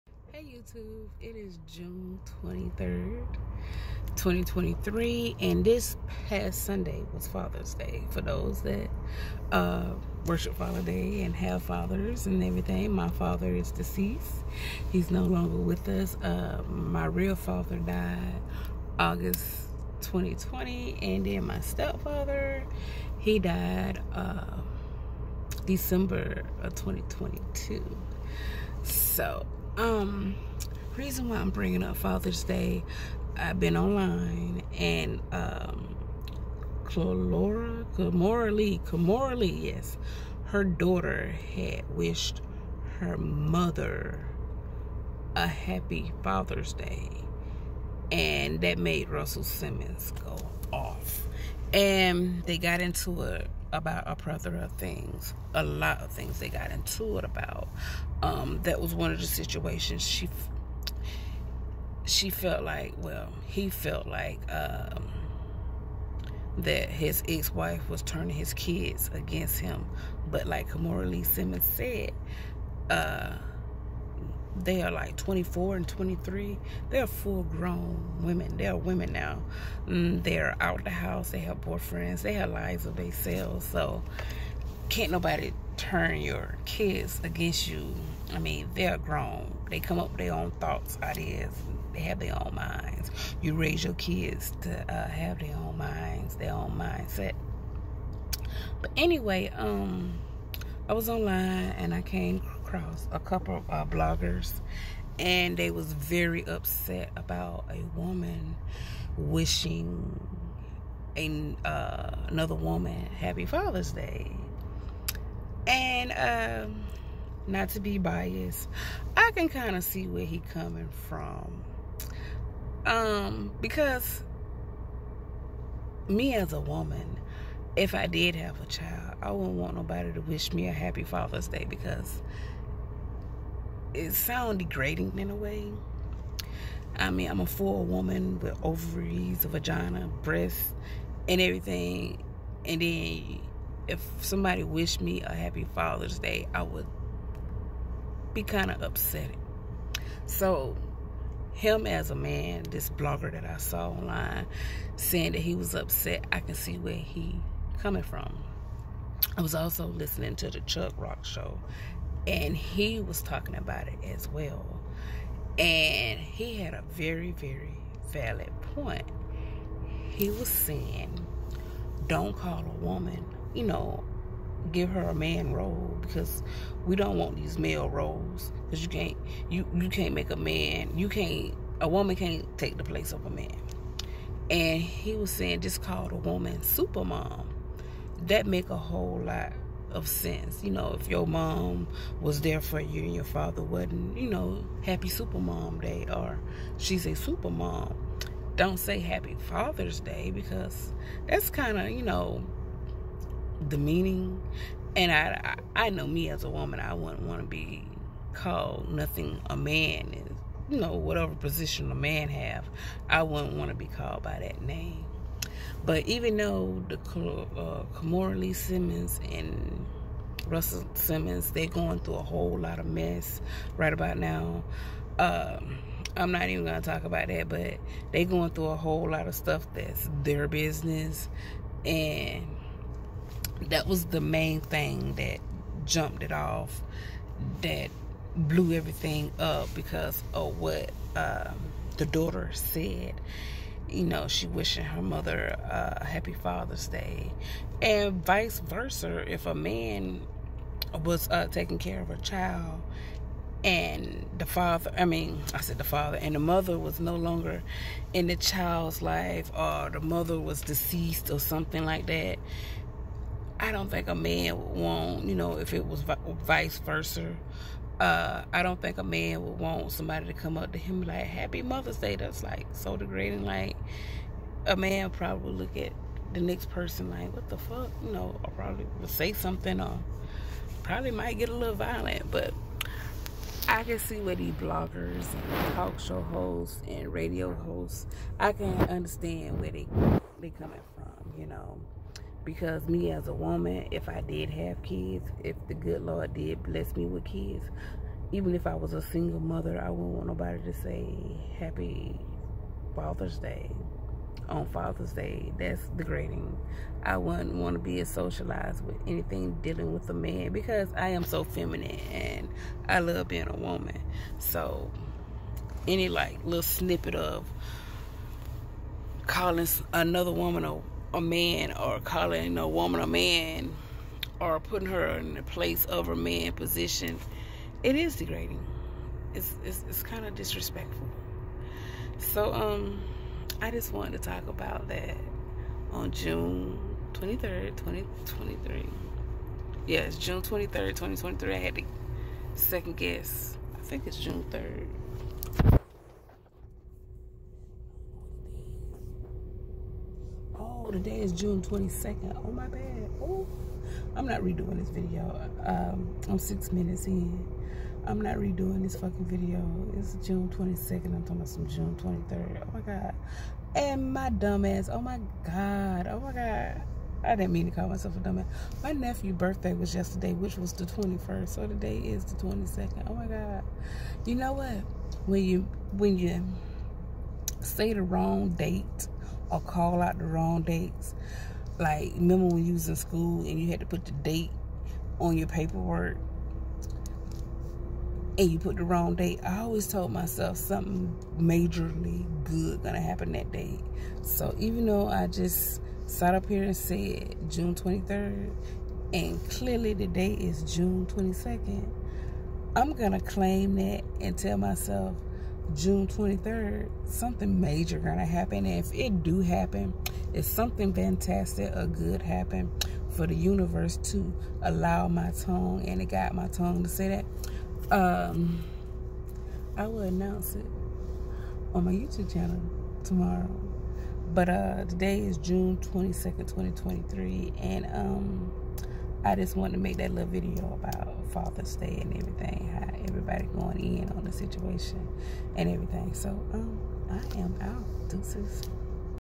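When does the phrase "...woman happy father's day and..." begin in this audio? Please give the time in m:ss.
1:52.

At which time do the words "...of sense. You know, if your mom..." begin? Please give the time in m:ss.
3:09.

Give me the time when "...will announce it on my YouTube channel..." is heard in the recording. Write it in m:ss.
6:59.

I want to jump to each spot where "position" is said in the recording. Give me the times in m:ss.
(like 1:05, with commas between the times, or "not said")
3:31, 5:26.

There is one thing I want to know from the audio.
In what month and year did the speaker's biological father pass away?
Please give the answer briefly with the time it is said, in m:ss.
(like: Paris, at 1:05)
August 2020, at 0:18.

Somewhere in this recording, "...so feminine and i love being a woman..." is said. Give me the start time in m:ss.
5:11.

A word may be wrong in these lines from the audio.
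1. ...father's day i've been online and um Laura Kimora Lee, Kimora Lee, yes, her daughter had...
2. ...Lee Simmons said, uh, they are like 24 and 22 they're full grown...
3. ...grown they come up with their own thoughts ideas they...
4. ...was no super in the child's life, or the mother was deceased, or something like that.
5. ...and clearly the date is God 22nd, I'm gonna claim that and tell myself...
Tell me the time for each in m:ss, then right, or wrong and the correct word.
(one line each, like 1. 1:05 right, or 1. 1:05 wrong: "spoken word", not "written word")
1. 0:31 right
2. 1:11 wrong: "23", not "22"
3. 1:28 right
4. 4:16 wrong: "longer", not "super"
5. 6:39 wrong: "June", not "God".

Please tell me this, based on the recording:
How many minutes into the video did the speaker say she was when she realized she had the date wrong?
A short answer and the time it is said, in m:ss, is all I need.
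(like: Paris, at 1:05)
6, at 5:56.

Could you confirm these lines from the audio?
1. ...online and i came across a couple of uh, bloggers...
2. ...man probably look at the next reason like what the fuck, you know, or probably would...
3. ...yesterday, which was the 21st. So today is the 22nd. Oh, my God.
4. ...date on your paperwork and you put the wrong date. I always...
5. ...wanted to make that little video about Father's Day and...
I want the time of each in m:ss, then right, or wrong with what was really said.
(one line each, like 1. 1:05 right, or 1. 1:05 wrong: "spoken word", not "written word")
1. 1:41 right
2. 4:34 wrong: "person", not "reason"
3. 6:09 right
4. 6:24 right
5. 7:09 right.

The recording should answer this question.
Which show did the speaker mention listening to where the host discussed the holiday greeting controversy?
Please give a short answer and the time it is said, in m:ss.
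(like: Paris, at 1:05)
Chuck Rock show, at 2:40.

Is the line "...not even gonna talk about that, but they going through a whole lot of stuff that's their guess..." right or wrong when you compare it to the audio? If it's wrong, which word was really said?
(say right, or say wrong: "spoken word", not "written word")
wrong: "business", not "guess".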